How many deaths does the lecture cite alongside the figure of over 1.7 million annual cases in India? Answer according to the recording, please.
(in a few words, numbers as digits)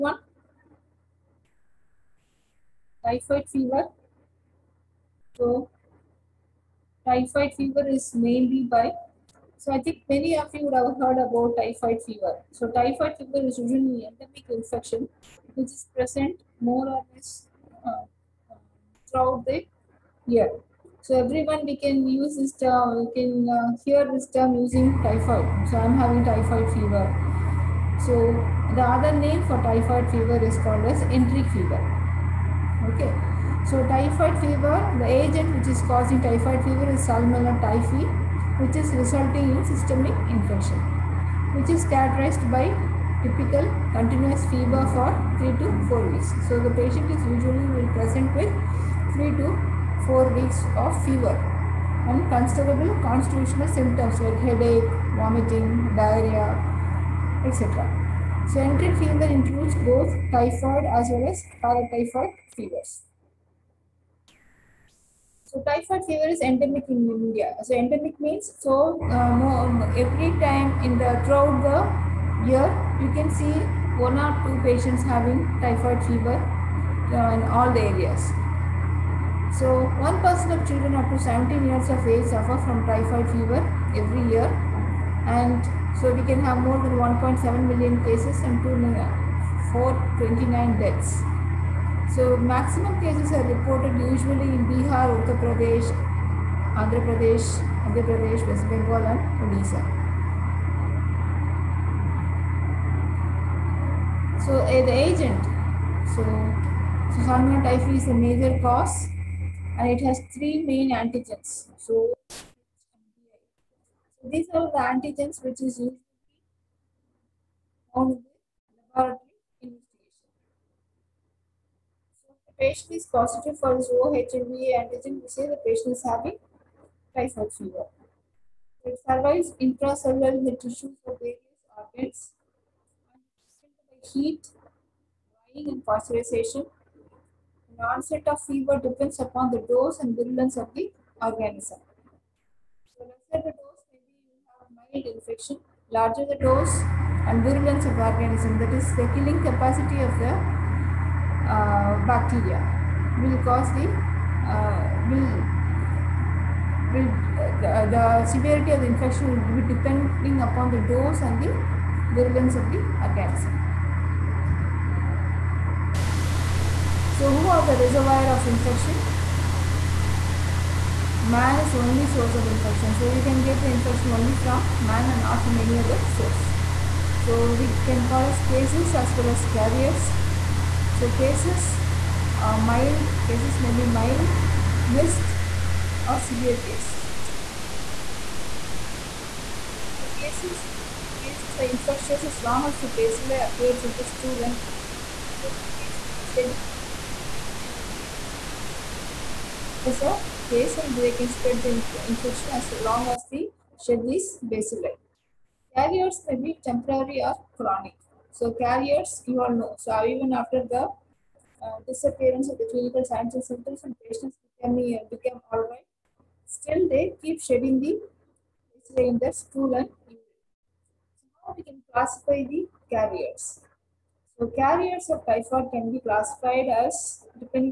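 429.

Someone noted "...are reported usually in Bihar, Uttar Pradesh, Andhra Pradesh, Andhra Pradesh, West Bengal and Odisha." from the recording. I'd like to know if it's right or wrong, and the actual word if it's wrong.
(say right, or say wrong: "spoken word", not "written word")
right.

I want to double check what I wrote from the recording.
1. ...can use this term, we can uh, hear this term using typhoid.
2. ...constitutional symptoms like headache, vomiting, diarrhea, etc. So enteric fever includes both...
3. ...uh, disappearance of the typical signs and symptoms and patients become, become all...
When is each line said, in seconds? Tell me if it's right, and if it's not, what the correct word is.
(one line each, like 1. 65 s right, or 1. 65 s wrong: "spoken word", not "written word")
1. 21 s right
2. 53 s right
3. 211 s wrong: "clinical", not "typical".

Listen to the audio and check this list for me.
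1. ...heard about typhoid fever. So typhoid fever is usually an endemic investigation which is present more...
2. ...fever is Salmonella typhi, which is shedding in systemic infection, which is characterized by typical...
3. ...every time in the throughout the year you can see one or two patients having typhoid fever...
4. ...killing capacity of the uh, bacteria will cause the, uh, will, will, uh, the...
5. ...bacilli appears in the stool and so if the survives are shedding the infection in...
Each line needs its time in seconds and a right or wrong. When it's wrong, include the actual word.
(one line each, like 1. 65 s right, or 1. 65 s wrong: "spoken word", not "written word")
1. 11 s wrong: "infection", not "investigation"
2. 36 s wrong: "resulting", not "shedding"
3. 69 s right
4. 149 s right
5. 192 s wrong: "cases", not "survives".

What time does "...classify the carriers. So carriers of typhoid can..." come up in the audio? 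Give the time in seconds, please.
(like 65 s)
221 s.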